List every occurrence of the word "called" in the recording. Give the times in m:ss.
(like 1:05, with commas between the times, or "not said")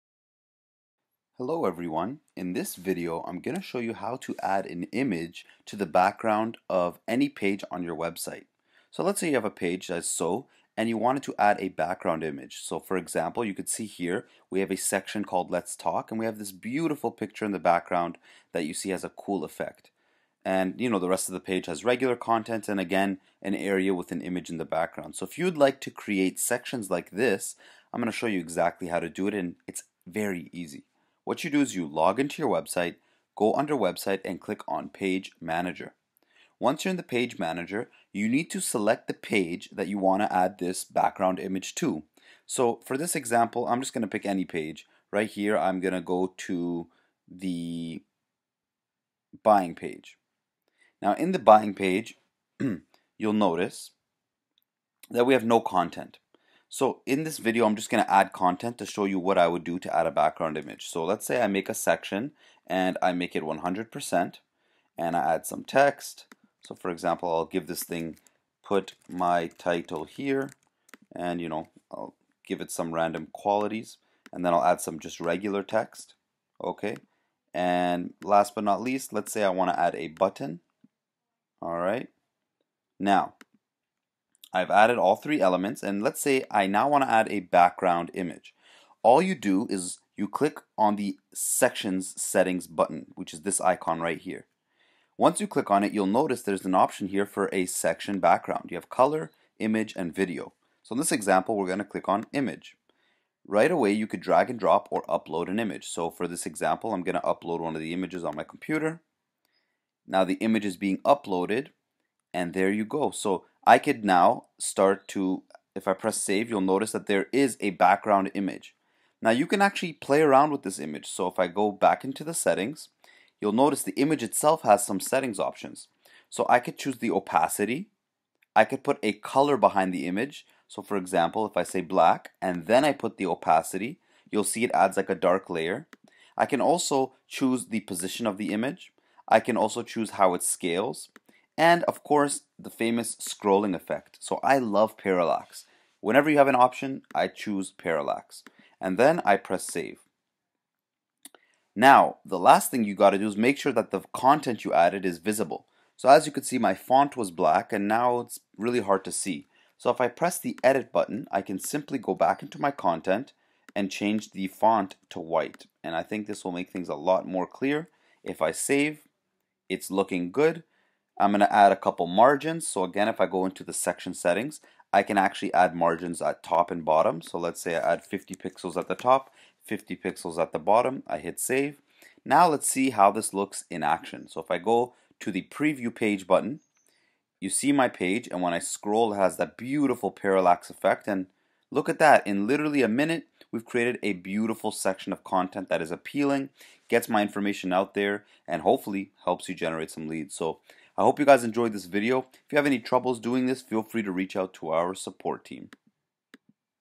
0:15.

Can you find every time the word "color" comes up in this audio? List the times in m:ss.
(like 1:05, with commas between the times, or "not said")
1:38, 2:09.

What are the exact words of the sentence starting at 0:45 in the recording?
Right here, I'm going to go to the buying page.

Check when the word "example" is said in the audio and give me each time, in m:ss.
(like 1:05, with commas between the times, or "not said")
0:12, 0:43, 1:06, 1:41, 1:46, 2:10.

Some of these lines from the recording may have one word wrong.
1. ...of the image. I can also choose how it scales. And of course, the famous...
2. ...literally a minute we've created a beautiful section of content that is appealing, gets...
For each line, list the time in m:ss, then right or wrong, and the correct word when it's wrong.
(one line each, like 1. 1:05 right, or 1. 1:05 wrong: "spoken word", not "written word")
1. 2:18 right
2. 3:12 right.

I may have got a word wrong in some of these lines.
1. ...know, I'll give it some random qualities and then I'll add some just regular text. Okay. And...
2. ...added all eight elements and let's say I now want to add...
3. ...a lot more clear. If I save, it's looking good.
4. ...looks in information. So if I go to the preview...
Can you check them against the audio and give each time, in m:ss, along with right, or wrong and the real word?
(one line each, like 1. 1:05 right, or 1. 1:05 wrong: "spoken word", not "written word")
1. 1:11 right
2. 1:24 wrong: "three", not "eight"
3. 2:46 right
4. 3:03 wrong: "action", not "information".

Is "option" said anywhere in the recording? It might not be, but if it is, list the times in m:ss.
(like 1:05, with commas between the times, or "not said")
1:36, 2:05, 2:26.